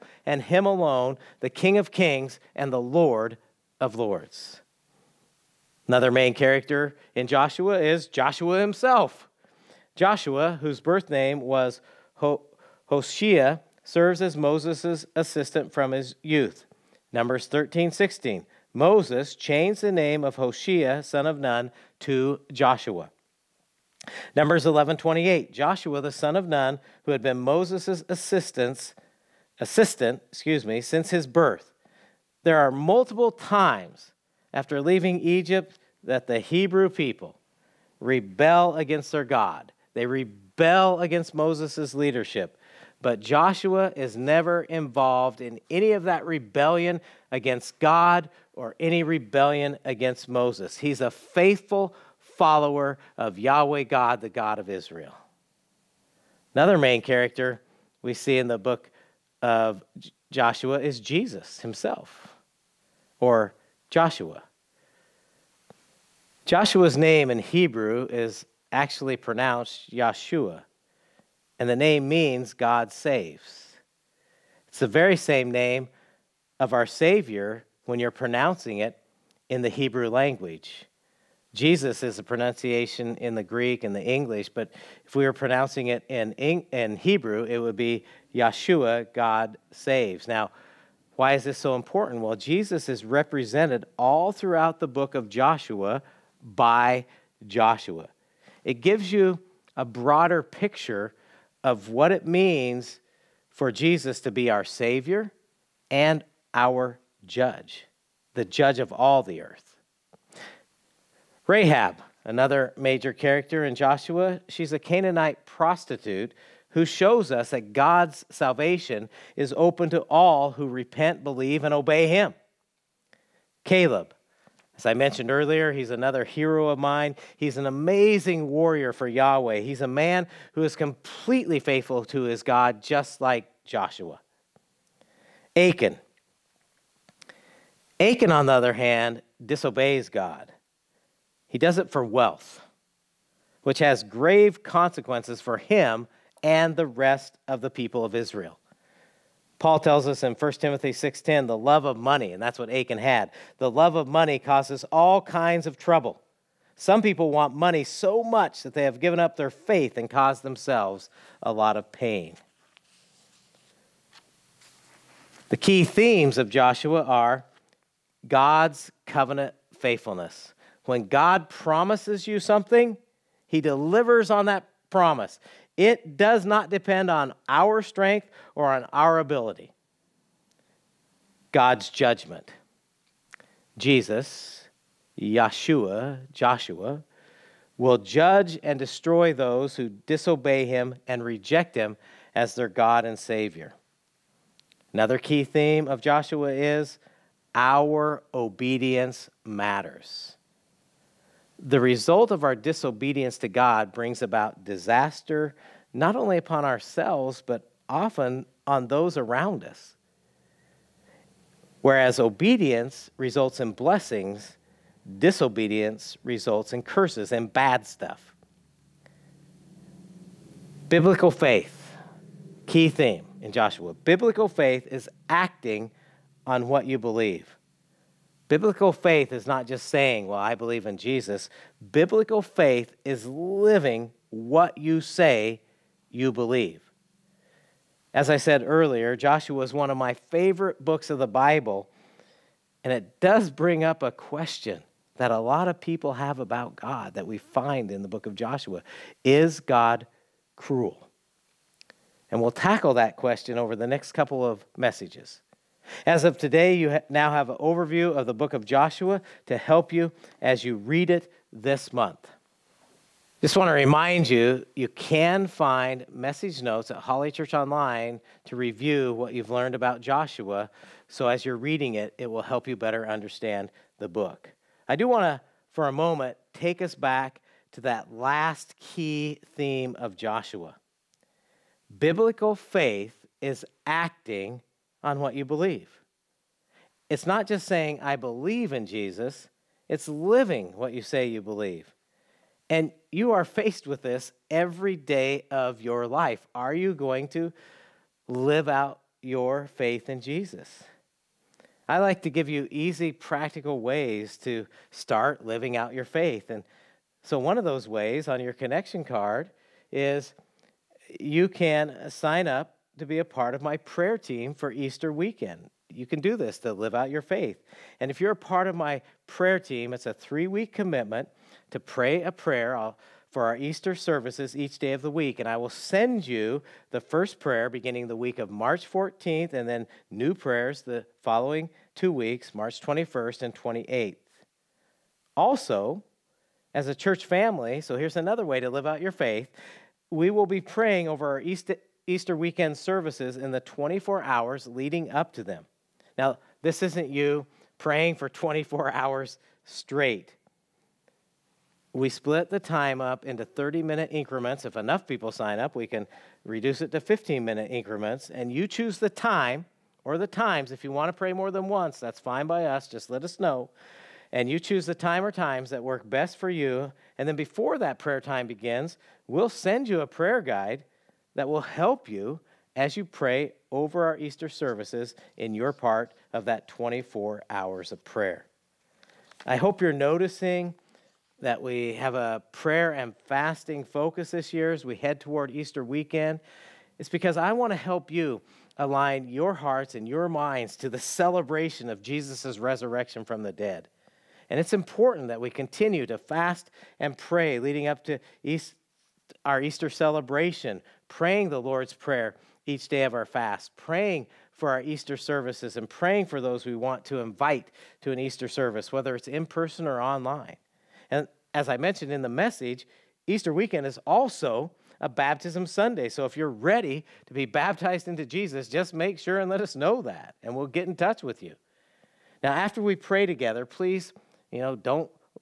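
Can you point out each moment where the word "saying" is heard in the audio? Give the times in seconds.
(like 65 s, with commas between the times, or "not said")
229 s, 287 s.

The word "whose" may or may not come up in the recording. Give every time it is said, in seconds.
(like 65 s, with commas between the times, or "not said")
10 s.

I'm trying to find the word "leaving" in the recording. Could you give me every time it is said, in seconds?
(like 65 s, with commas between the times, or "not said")
34 s.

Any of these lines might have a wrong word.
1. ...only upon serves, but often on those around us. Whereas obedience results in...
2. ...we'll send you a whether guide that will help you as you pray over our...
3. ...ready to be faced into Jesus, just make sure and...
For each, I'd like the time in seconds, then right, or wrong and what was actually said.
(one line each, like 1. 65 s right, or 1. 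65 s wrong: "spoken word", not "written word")
1. 206 s wrong: "ourselves", not "serves"
2. 369 s wrong: "prayer", not "whether"
3. 416 s wrong: "baptized", not "faced".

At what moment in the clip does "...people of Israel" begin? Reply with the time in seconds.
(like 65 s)
147 s.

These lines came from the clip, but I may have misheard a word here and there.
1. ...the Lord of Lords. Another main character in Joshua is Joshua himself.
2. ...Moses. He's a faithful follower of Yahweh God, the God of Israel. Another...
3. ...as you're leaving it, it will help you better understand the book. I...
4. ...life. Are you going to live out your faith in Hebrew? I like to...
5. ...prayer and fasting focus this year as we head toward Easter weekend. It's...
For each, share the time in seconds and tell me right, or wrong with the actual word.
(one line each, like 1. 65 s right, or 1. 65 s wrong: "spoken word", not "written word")
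1. 2 s right
2. 50 s right
3. 271 s wrong: "reading", not "leaving"
4. 296 s wrong: "Jesus", not "Hebrew"
5. 382 s right.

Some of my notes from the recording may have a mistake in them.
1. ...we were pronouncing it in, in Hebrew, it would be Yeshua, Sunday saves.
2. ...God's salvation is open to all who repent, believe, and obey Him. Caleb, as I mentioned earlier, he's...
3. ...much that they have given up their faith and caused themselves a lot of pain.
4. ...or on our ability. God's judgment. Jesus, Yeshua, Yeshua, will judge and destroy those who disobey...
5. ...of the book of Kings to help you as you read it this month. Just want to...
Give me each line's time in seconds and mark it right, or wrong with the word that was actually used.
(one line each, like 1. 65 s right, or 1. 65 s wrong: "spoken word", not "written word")
1. 85 s wrong: "God", not "Sunday"
2. 117 s right
3. 158 s right
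4. 178 s wrong: "Joshua", not "Yeshua"
5. 258 s wrong: "Joshua", not "Kings".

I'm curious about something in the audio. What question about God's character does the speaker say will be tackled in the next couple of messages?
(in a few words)
Is God cruel?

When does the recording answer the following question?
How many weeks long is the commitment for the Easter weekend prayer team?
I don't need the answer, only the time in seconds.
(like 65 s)
320 s.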